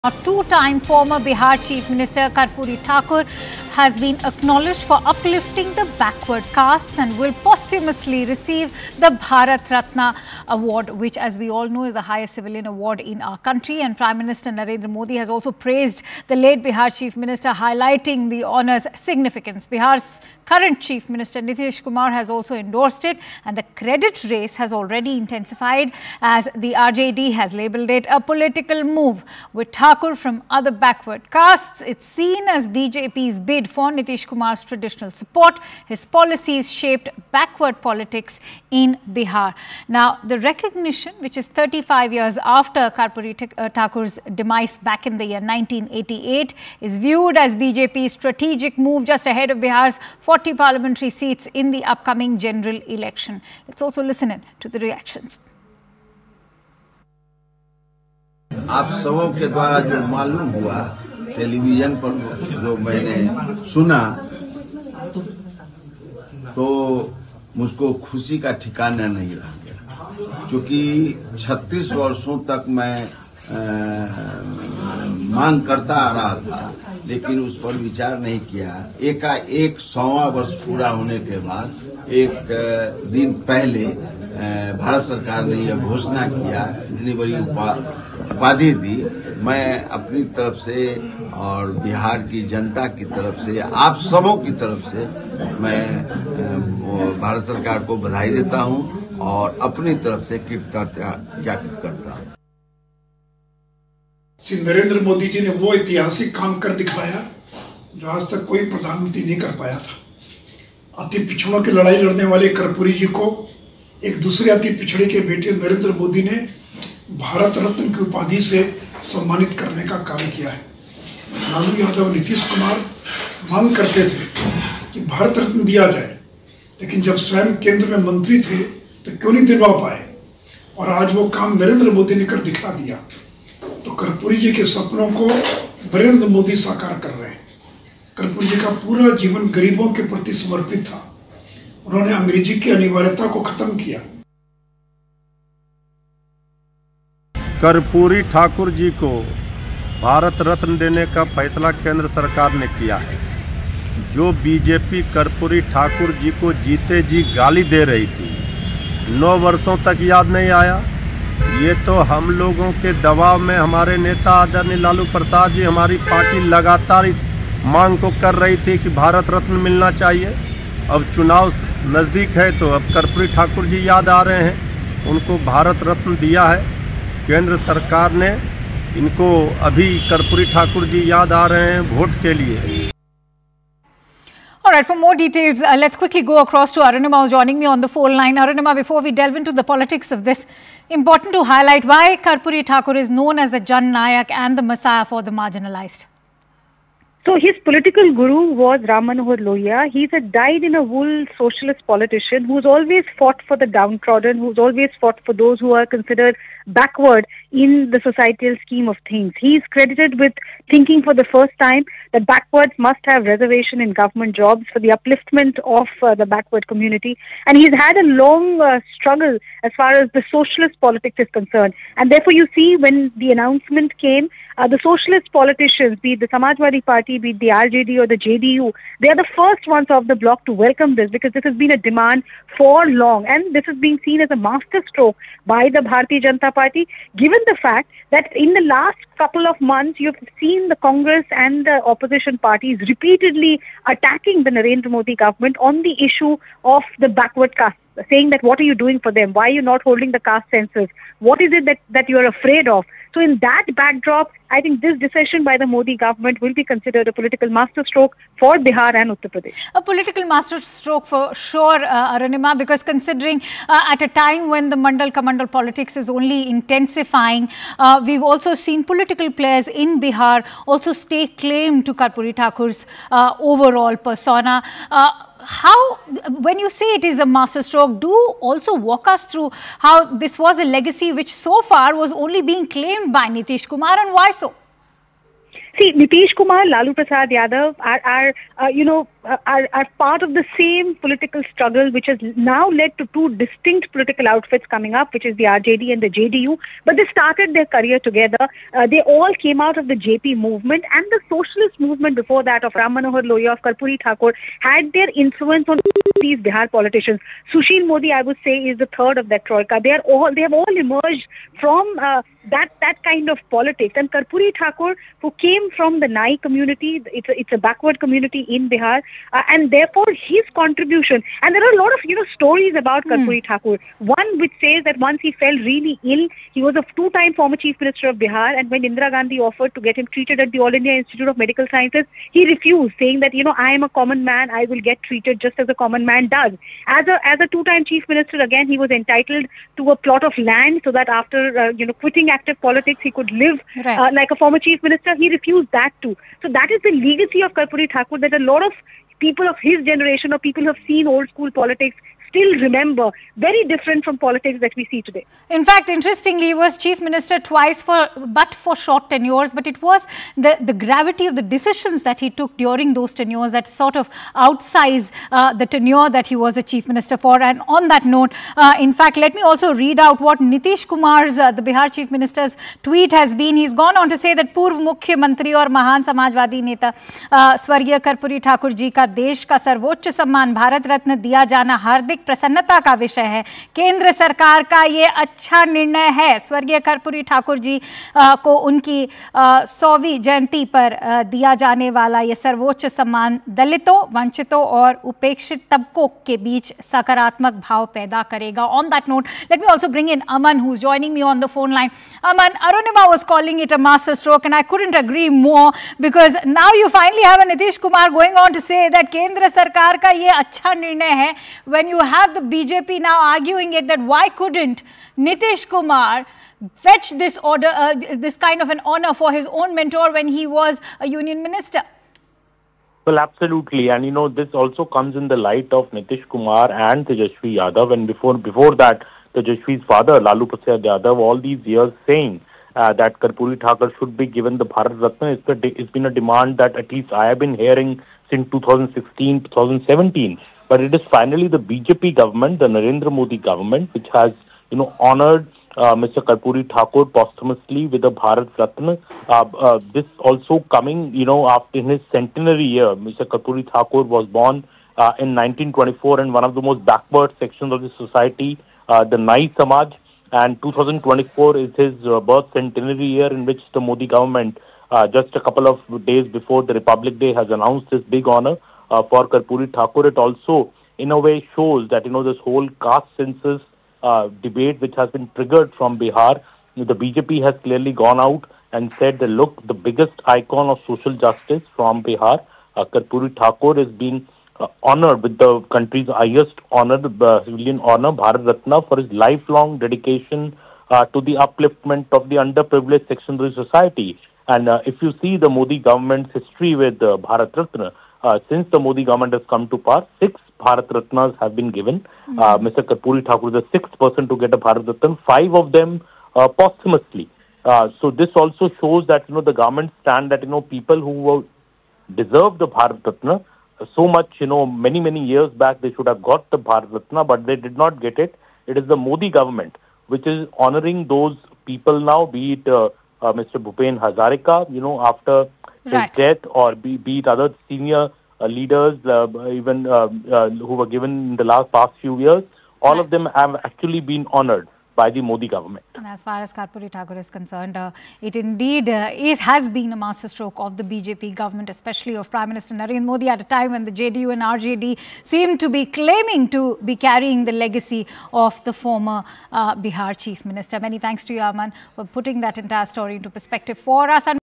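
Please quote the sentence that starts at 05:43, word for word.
uh, like a former chief minister.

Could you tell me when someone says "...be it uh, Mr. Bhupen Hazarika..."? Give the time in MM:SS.
08:42.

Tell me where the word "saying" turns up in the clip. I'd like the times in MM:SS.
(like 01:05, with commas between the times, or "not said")
04:08, 05:32, 07:12.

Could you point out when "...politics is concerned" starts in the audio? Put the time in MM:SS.
03:40.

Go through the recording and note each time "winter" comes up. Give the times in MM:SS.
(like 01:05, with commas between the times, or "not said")
not said.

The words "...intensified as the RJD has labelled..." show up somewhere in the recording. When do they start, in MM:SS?
00:25.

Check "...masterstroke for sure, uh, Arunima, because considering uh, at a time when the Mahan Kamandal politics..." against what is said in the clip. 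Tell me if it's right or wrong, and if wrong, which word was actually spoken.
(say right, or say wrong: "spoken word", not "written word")
wrong: "Mandal", not "Mahan".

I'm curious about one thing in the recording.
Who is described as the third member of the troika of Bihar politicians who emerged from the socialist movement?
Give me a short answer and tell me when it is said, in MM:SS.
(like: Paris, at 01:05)
Sushil Modi, at 05:07.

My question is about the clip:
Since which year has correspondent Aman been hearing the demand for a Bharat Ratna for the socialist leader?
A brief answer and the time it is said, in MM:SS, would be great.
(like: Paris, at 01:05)
2016, at 07:18.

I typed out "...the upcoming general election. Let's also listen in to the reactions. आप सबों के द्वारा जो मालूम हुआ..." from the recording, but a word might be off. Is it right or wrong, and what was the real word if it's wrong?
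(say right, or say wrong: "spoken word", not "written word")
right.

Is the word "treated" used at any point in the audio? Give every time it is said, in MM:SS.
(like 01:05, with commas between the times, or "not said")
05:30, 05:35.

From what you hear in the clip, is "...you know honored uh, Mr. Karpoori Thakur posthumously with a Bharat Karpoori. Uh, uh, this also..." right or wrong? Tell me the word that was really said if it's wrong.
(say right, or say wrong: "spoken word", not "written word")
wrong: "Ratna", not "Karpoori".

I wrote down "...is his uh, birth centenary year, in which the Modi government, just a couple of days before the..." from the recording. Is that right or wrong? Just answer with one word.
right.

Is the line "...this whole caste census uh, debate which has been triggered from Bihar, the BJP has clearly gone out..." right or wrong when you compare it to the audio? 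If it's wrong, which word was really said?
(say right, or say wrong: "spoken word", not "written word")
right.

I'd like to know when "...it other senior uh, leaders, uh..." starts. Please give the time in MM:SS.
08:47.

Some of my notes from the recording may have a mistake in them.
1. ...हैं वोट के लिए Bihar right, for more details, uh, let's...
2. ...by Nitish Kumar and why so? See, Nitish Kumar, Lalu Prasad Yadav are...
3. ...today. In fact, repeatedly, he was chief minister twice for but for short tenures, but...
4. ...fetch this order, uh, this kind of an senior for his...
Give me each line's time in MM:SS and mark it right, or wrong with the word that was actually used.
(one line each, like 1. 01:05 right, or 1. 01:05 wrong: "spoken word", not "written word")
1. 03:01 wrong: "All", not "Bihar"
2. 04:43 right
3. 05:55 wrong: "interestingly", not "repeatedly"
4. 06:56 wrong: "honor", not "senior".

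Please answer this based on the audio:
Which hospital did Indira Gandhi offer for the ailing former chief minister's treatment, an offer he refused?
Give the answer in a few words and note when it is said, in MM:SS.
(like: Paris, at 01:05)
All India Institute of Medical Sciences, at 05:30.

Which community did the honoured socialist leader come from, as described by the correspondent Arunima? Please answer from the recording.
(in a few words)
Nai community.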